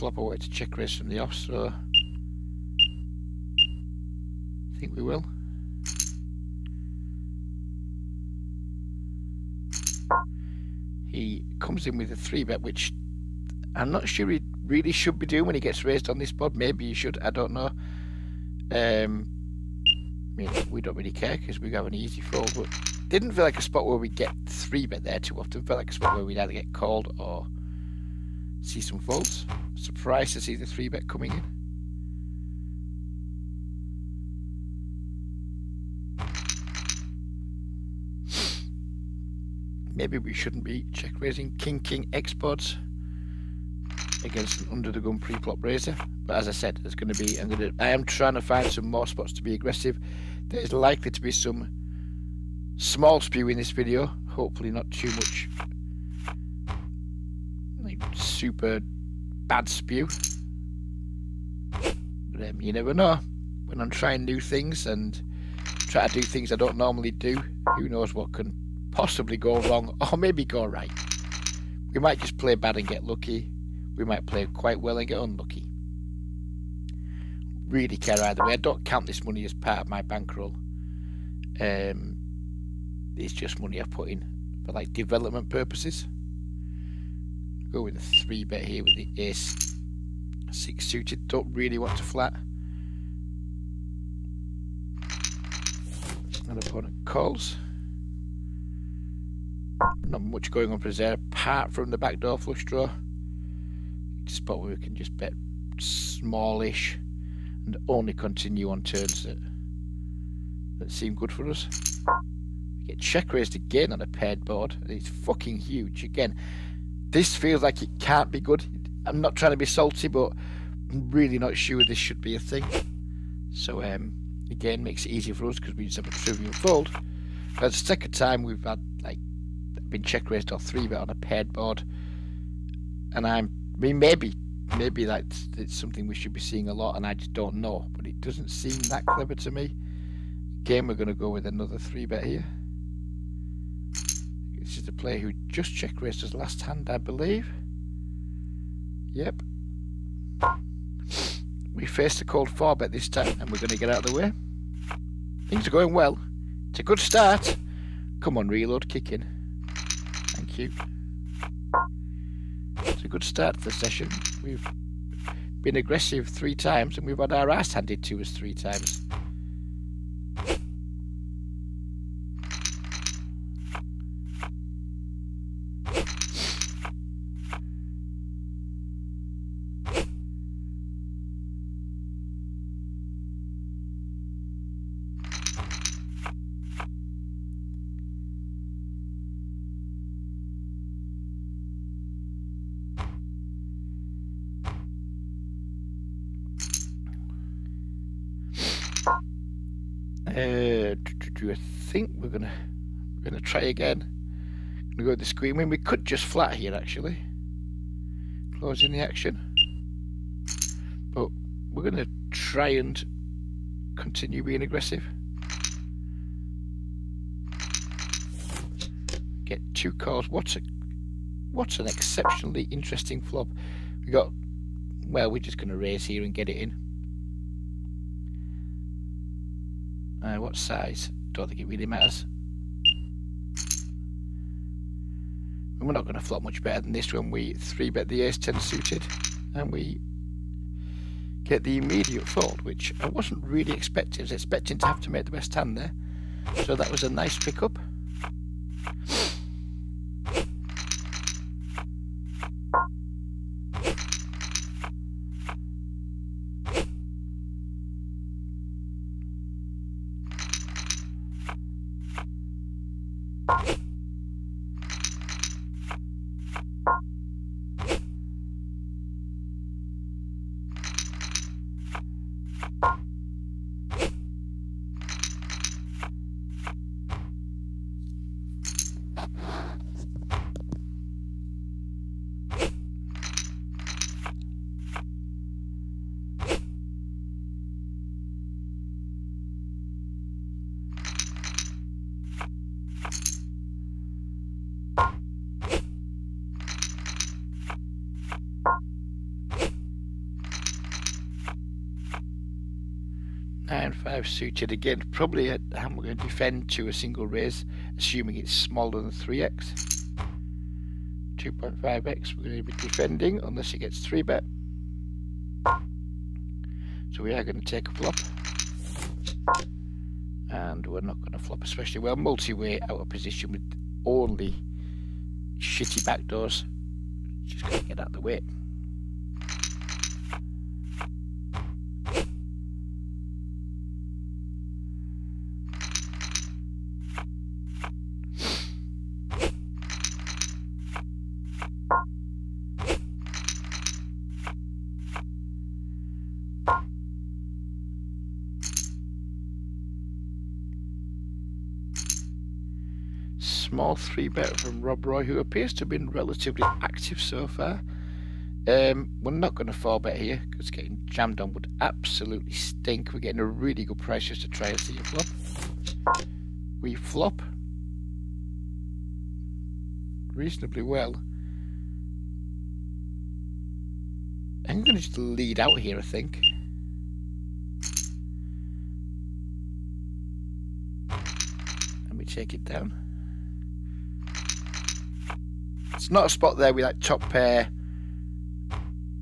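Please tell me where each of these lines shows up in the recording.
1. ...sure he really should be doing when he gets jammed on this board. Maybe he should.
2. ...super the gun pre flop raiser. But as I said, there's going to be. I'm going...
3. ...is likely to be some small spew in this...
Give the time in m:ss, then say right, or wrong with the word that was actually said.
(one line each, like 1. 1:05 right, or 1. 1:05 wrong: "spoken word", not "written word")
1. 0:14 wrong: "raised", not "jammed"
2. 0:44 wrong: "under", not "super"
3. 0:50 right.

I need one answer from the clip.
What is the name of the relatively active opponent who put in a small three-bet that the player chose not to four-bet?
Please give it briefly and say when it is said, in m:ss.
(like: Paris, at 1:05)
Rob Roy, at 5:54.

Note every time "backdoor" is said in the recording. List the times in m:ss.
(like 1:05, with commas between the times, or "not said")
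1:41, 5:26.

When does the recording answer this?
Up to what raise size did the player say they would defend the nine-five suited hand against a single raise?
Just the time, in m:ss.
5:09.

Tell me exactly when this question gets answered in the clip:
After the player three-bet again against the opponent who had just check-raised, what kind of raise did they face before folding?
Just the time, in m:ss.
2:32.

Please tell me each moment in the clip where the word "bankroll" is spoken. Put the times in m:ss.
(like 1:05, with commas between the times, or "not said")
1:20.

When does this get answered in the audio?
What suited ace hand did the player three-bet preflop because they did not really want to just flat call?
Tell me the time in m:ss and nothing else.
1:29.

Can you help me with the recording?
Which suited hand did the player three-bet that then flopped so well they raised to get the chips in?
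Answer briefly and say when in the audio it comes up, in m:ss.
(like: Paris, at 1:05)
ace-10 suited, at 3:58.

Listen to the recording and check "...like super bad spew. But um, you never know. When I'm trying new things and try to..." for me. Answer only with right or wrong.
right.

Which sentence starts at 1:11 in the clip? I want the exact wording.
We might just play bad and get lucky.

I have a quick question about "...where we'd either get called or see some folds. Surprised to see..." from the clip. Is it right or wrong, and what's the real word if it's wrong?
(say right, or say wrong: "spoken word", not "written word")
right.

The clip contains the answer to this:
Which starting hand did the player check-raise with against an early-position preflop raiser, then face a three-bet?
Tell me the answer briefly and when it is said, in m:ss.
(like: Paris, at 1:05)
King King, at 0:41.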